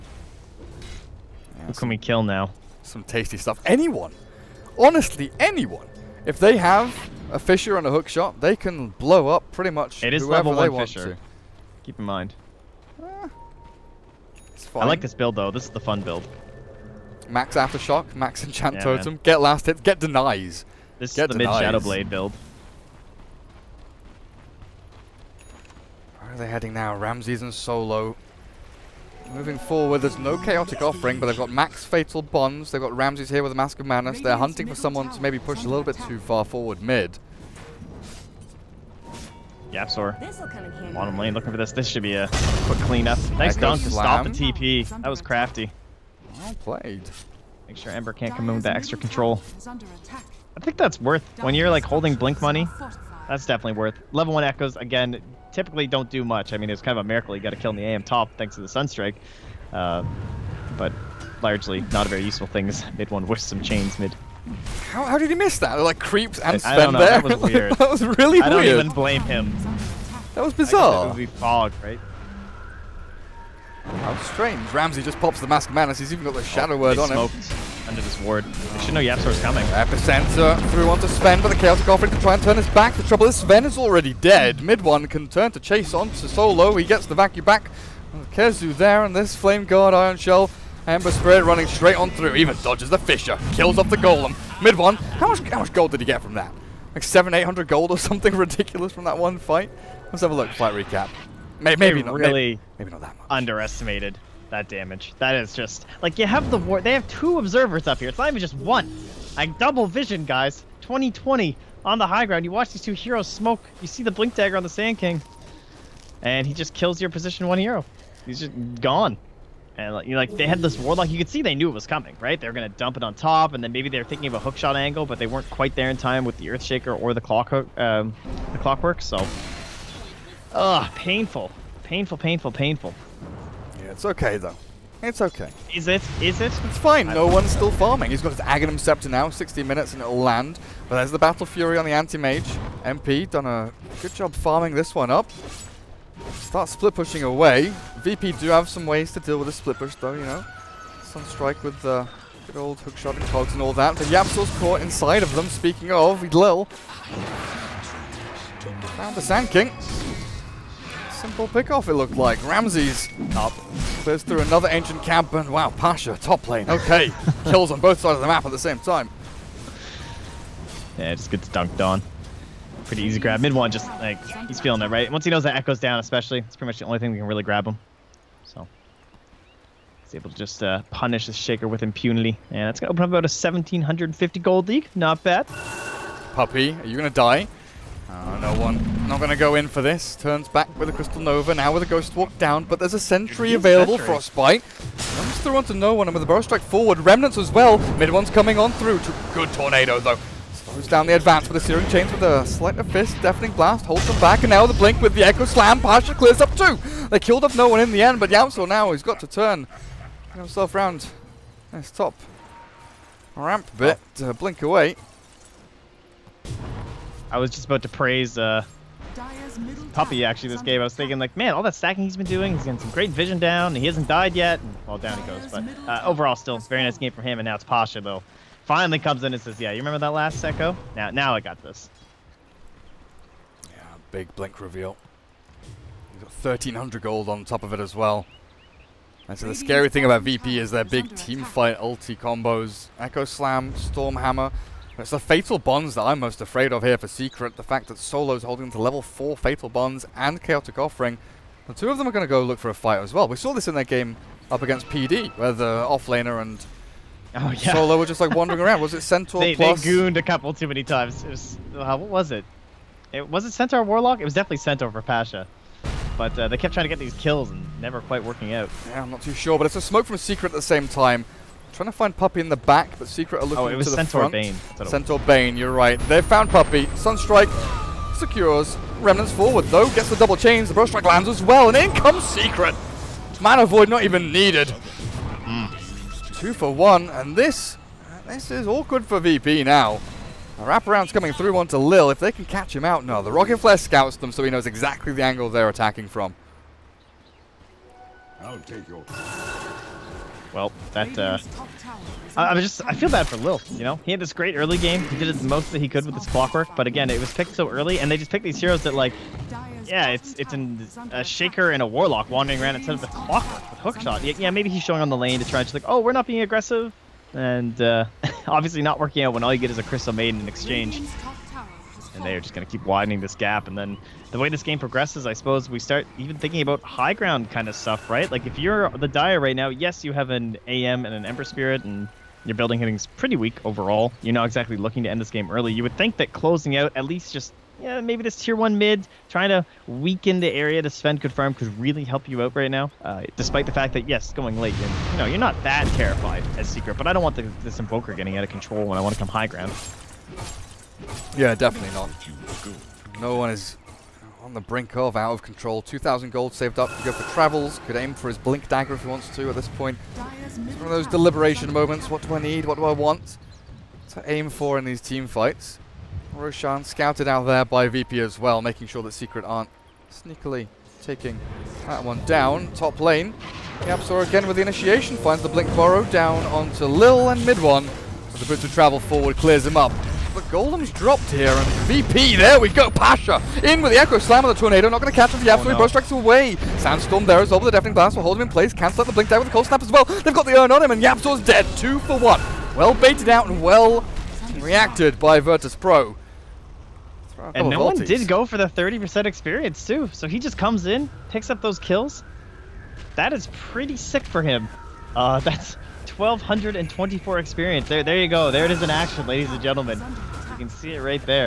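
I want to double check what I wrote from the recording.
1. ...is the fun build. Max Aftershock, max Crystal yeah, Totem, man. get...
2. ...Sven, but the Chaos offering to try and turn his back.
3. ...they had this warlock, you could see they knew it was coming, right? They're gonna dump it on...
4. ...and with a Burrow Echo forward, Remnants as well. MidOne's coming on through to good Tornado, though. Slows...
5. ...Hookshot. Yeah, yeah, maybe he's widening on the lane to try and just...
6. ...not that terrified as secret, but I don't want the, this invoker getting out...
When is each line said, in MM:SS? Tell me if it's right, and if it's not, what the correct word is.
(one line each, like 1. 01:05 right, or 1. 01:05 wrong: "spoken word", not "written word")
1. 00:15 wrong: "Enchant", not "Crystal"
2. 01:21 right
3. 02:00 right
4. 03:16 wrong: "Strike", not "Echo"
5. 05:13 wrong: "showing", not "widening"
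6. 05:45 right.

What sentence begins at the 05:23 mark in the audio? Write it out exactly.
And then the way this game progresses, I suppose we start even thinking about high ground kind of stuff, right?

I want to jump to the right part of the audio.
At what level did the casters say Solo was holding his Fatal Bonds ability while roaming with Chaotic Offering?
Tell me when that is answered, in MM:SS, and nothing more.
04:08.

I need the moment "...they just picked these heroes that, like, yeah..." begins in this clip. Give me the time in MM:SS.
05:08.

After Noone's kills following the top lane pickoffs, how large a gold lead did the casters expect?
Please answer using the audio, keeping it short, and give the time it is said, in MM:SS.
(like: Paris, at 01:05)
1750, at 03:03.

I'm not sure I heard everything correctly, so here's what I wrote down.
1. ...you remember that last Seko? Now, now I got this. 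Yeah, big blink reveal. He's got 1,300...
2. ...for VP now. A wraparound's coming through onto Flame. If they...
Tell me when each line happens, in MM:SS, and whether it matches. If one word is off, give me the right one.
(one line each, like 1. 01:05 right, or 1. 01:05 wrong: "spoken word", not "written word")
1. 03:49 right
2. 04:49 wrong: "Lil", not "Flame".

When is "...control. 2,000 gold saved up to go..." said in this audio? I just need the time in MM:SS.
05:55.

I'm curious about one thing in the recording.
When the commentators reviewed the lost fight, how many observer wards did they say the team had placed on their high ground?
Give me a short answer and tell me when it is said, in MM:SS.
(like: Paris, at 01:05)
2, at 01:47.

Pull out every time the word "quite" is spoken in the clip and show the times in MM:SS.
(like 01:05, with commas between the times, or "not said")
02:05, 04:28.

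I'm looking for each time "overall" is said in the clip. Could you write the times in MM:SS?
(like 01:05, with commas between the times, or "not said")
03:46, 05:33.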